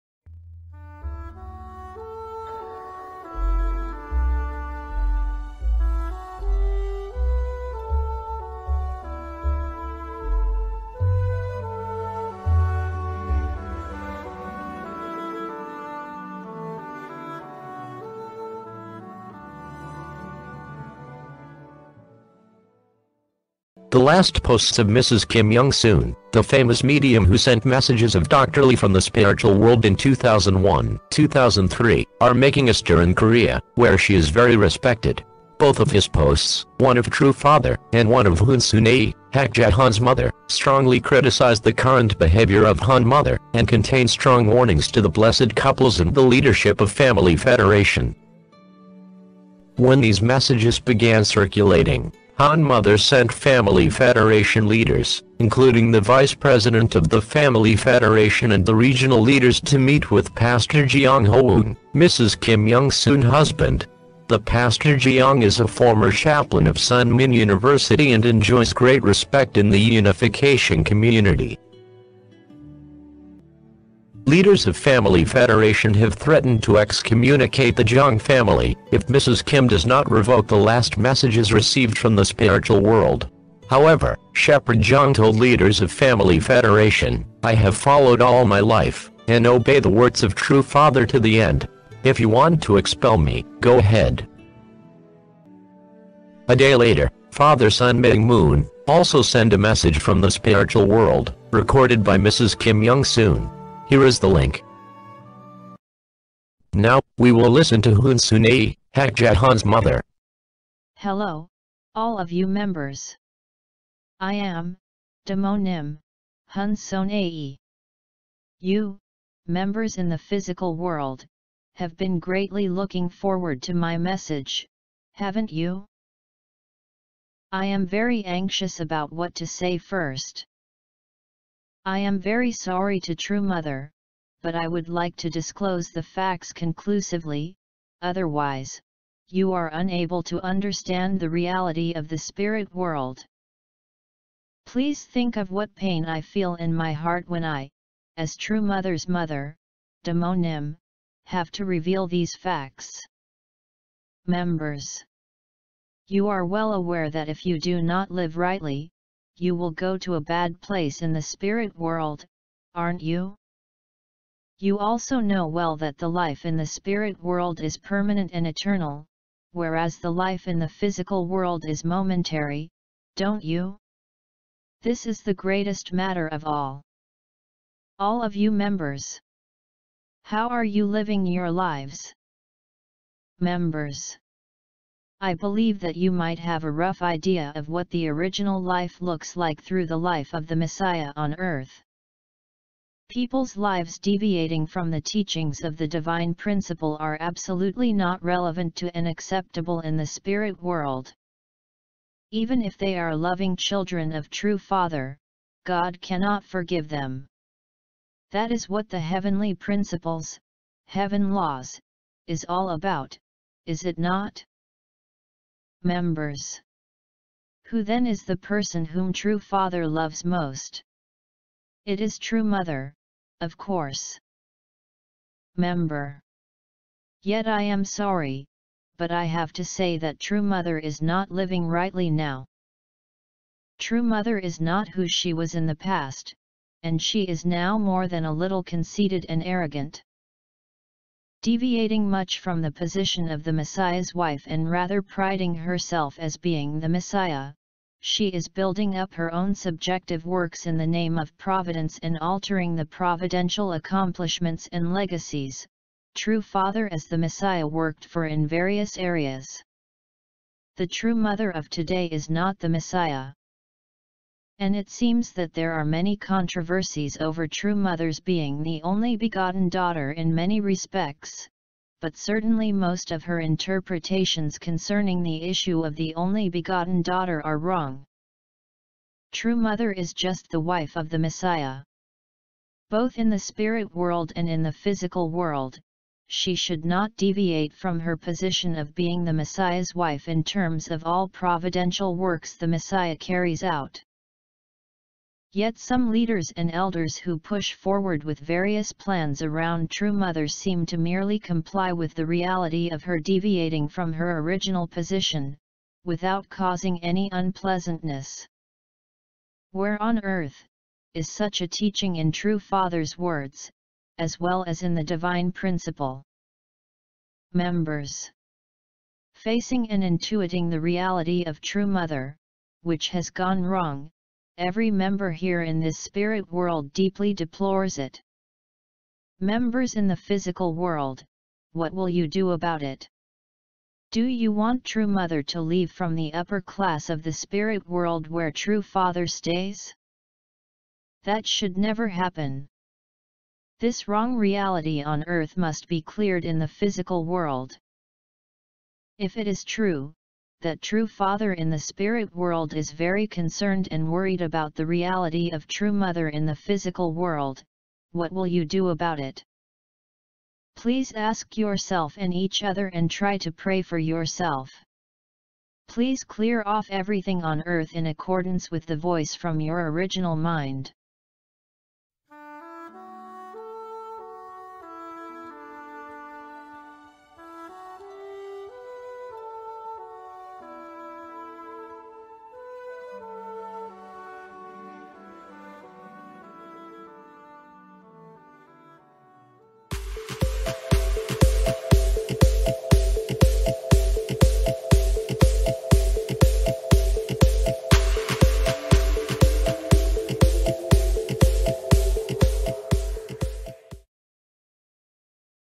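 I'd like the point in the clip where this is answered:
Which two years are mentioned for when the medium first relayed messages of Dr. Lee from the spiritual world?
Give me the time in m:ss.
0:29.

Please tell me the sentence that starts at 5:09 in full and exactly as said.
Where on earth, is such a teaching in True Father's words, as well as in the Divine Principle?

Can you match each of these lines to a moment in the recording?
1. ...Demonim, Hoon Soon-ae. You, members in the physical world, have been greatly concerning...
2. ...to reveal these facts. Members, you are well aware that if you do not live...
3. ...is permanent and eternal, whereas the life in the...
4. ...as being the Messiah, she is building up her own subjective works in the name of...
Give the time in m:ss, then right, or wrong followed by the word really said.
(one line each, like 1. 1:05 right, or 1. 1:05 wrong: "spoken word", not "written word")
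1. 1:55 wrong: "looking", not "concerning"
2. 2:31 right
3. 2:47 right
4. 4:06 right.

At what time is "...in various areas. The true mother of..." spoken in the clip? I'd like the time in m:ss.
4:18.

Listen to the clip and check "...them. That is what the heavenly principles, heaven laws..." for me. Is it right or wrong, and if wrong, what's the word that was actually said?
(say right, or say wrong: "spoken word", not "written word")
right.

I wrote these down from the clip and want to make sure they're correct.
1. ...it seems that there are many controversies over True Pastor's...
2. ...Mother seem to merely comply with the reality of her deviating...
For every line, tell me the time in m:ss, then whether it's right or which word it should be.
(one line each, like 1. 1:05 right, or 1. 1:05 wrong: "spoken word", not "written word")
1. 4:24 wrong: "Mother", not "Pastor"
2. 5:00 right.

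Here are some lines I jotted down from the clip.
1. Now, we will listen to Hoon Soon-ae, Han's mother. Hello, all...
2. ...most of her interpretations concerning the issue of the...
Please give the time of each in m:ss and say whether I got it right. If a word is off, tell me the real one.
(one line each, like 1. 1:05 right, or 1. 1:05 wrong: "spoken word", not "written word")
1. 1:46 right
2. 4:32 right.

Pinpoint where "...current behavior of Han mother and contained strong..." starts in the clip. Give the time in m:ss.
0:41.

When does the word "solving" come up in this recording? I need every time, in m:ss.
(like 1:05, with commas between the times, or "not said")
not said.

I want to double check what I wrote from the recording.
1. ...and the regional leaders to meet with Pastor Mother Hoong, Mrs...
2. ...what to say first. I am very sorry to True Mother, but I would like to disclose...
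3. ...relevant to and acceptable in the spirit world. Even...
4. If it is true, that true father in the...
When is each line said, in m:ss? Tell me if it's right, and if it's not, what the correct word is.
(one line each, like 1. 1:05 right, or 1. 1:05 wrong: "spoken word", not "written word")
1. 0:58 wrong: "Jeong", not "Mother"
2. 2:09 right
3. 3:18 right
4. 5:49 right.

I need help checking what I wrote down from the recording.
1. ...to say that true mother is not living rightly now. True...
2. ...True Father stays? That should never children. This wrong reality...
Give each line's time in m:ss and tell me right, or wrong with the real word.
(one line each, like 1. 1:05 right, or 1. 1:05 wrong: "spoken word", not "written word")
1. 3:49 right
2. 5:38 wrong: "happen", not "children".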